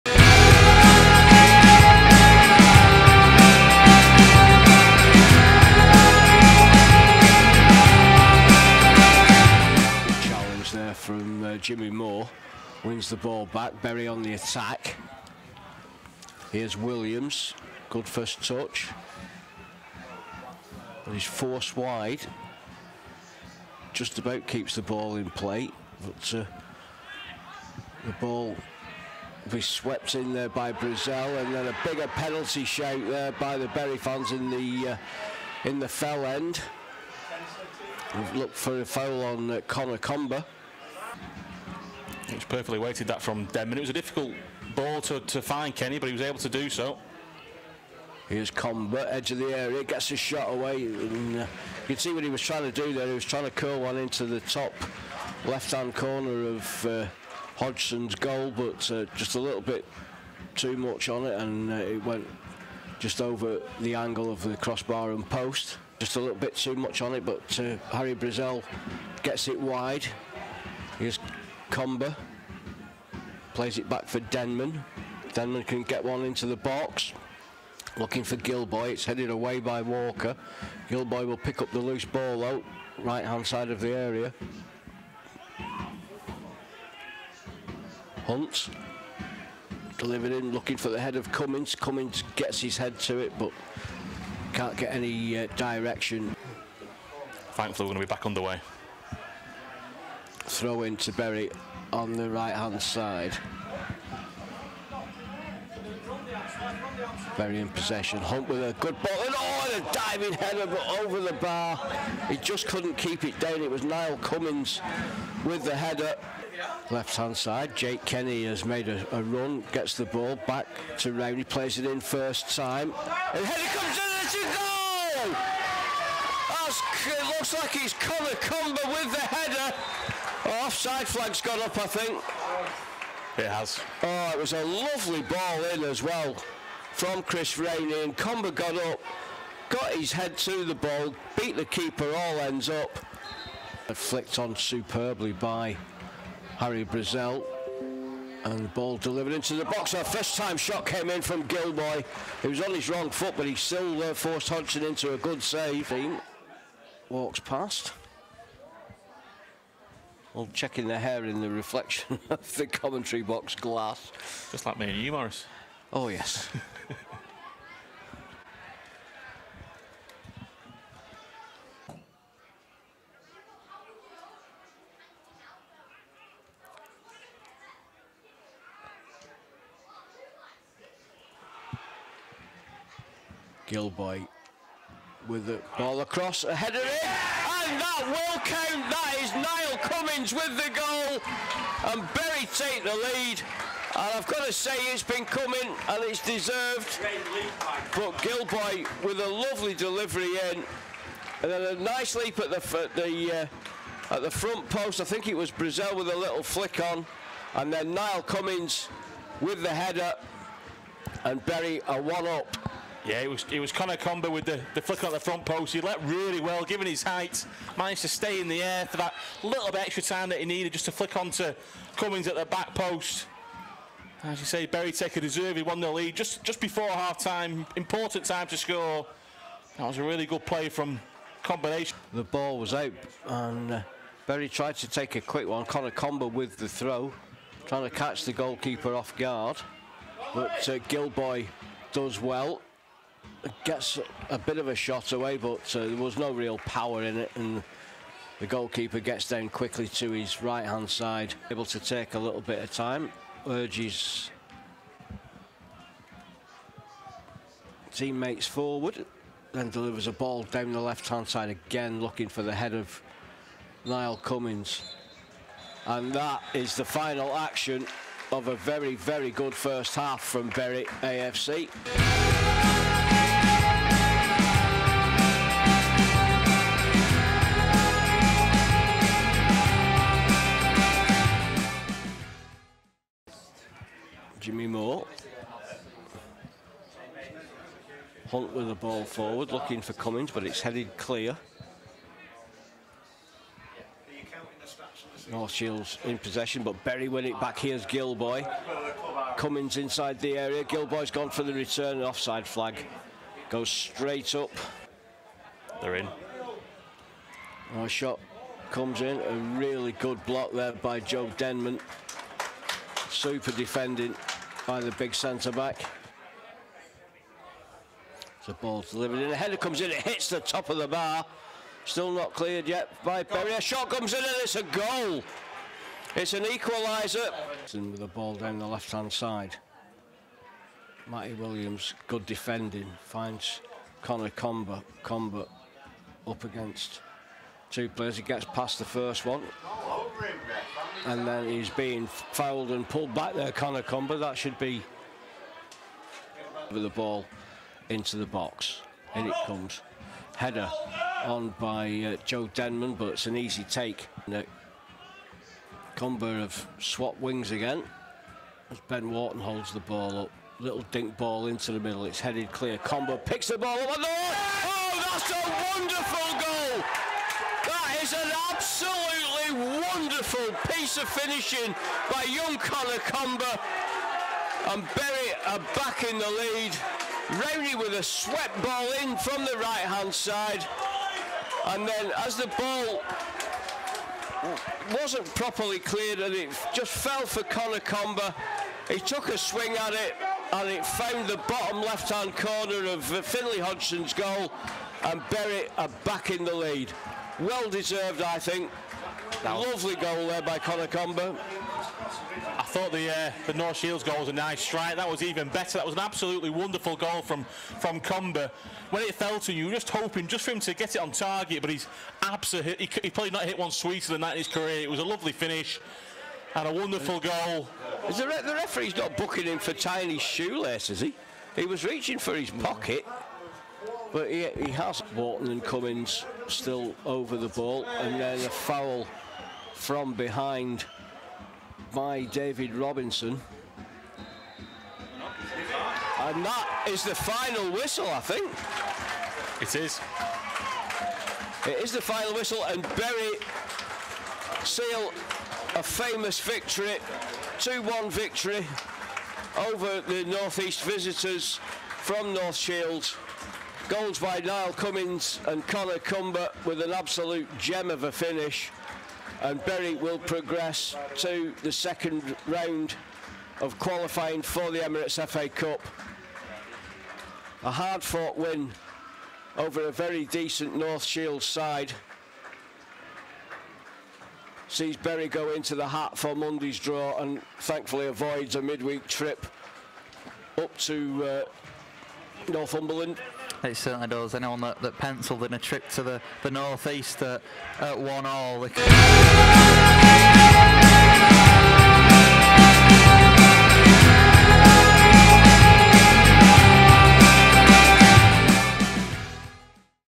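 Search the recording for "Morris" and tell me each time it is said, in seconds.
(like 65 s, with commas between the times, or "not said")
165 s.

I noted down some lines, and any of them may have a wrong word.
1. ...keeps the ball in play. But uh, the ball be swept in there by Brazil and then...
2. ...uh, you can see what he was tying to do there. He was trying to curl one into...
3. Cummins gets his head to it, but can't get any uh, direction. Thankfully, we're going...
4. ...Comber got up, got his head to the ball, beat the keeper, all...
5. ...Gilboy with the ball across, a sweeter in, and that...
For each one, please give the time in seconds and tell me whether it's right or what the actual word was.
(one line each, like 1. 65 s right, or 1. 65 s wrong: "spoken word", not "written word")
1. 24 s right
2. 51 s wrong: "trying", not "tying"
3. 91 s right
4. 138 s right
5. 183 s wrong: "header", not "sweeter".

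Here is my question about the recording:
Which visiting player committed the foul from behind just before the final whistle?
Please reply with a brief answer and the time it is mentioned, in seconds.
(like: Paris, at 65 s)
David Robinson, at 428 s.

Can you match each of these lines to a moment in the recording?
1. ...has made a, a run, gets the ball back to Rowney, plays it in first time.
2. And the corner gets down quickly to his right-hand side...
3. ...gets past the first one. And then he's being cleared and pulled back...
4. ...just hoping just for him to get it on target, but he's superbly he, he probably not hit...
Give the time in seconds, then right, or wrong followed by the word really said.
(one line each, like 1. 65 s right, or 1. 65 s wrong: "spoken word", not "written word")
1. 118 s right
2. 247 s wrong: "goalkeeper", not "corner"
3. 338 s wrong: "fouled", not "cleared"
4. 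409 s wrong: "absolutely", not "superbly".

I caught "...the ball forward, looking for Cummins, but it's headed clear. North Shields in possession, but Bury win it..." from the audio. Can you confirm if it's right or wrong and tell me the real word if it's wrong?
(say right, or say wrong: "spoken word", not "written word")
right.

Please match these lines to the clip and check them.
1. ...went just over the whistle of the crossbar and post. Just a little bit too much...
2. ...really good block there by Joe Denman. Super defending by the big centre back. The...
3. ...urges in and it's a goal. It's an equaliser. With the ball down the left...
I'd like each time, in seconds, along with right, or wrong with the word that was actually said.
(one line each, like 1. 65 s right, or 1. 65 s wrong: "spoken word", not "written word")
1. 62 s wrong: "angle", not "whistle"
2. 309 s right
3. 323 s wrong: "comes", not "urges".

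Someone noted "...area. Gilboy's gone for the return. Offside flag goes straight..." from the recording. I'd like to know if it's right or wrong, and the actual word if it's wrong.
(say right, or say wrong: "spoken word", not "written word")
right.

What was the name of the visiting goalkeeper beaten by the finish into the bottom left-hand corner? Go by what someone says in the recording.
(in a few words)
Finlay Hodgson.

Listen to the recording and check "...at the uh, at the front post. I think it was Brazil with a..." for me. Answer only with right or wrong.
right.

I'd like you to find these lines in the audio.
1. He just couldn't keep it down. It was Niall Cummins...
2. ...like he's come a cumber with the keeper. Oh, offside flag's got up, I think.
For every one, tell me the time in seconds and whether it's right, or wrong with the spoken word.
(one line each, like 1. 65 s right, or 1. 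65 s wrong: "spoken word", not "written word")
1. 112 s right
2. 127 s wrong: "header", not "keeper".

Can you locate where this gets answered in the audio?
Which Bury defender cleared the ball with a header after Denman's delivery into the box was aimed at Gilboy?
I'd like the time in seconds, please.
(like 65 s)
78 s.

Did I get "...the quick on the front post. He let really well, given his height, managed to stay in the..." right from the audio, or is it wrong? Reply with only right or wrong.
wrong.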